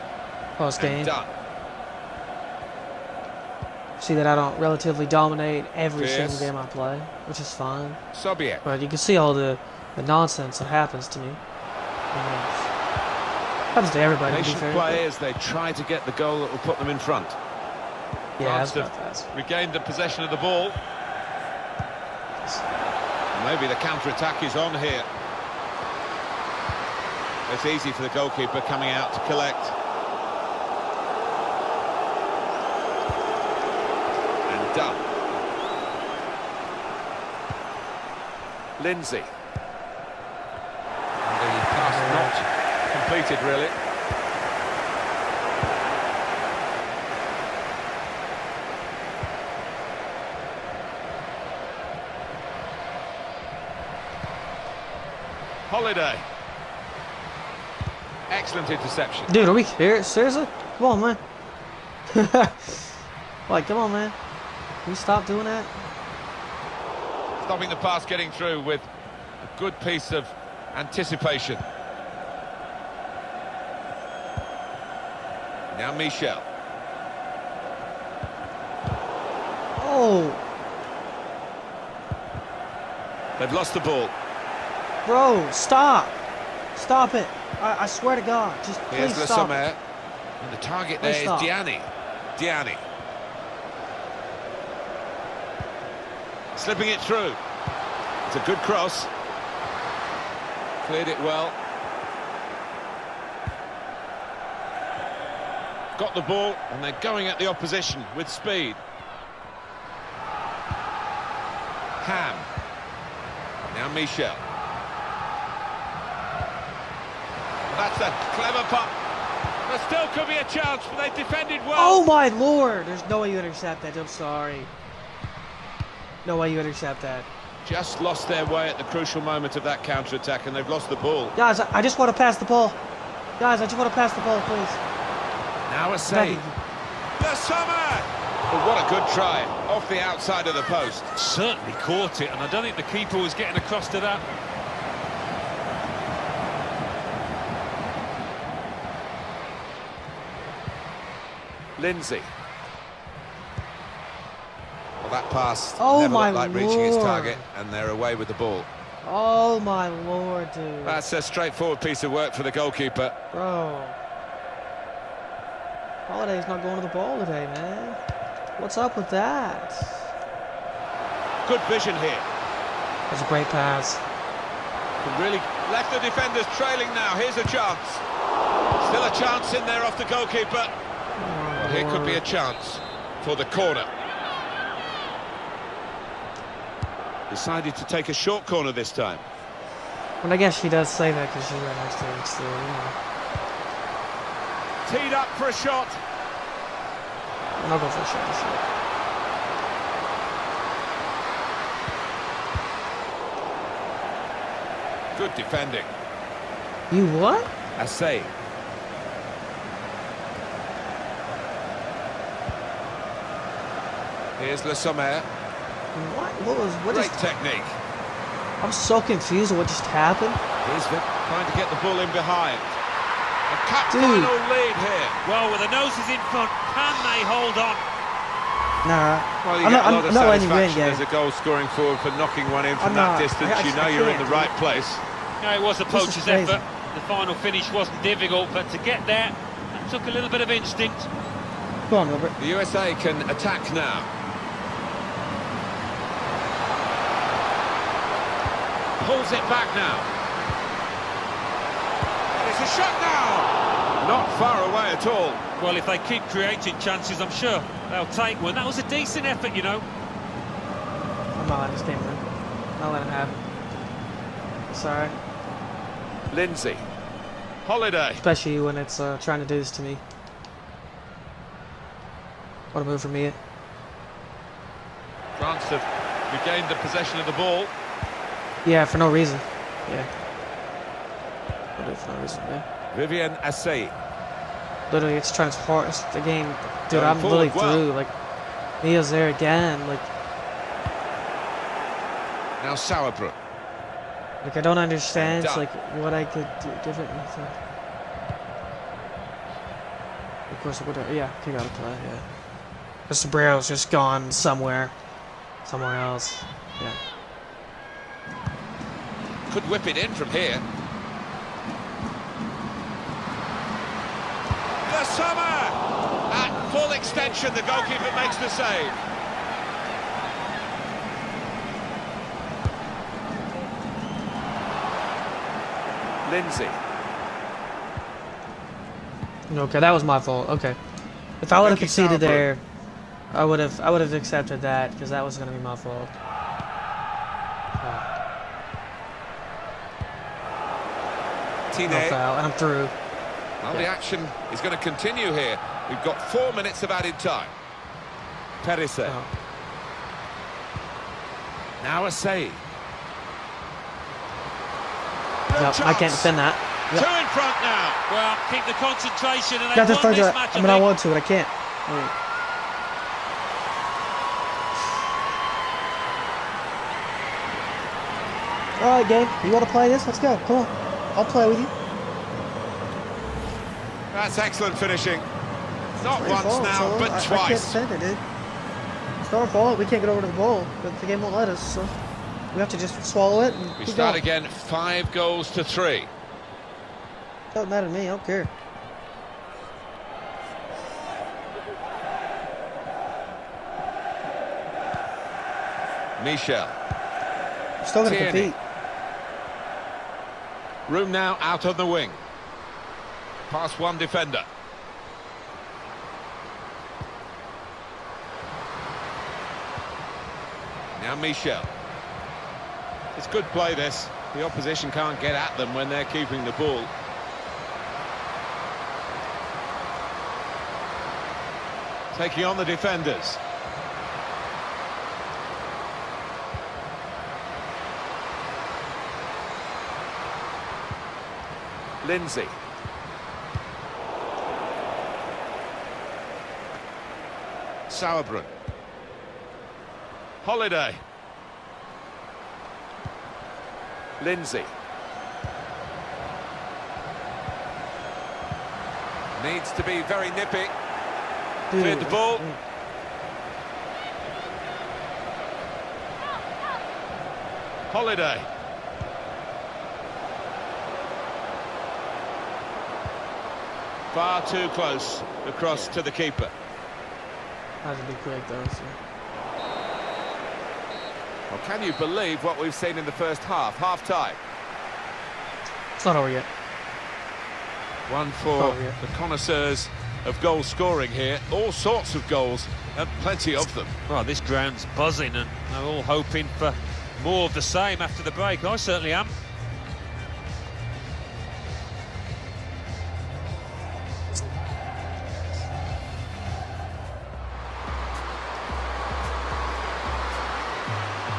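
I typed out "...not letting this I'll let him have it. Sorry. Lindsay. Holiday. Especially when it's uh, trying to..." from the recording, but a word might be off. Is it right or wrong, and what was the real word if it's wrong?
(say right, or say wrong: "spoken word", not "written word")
right.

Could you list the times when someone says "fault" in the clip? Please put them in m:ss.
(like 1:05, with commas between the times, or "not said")
5:30, 5:35.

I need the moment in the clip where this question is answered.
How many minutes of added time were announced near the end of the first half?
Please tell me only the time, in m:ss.
5:46.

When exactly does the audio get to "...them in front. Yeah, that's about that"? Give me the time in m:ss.
0:16.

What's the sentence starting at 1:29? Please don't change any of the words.
Here's and the target there please is stop.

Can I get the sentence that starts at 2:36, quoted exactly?
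reaching its target, and they're away with the ball.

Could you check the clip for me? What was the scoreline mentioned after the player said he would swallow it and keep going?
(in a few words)
5-3.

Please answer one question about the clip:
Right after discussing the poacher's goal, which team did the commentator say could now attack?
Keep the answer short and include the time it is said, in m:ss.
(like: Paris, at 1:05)
USA, at 4:02.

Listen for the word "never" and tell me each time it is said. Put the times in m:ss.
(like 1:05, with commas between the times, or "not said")
2:35.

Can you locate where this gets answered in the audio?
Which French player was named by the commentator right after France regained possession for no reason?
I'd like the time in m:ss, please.
4:42.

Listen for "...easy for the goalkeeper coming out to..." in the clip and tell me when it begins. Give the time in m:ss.
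0:27.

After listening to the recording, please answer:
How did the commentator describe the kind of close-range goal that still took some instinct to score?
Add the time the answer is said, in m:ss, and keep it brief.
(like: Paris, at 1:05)
a poacher's effort, at 3:55.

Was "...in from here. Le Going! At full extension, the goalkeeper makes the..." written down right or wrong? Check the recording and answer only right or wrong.
wrong.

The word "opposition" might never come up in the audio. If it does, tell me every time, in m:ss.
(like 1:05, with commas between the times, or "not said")
1:47, 6:54.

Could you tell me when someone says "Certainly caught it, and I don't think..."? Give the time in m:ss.
2:21.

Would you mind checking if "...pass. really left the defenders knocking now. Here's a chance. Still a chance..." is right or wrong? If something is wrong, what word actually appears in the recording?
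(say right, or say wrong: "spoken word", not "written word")
wrong: "trailing", not "knocking".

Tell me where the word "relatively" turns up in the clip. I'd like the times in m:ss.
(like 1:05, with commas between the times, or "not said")
0:04.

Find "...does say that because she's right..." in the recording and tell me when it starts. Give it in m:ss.
3:10.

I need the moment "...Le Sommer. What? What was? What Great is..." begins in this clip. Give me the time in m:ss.
3:34.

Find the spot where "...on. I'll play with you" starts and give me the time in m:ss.
6:10.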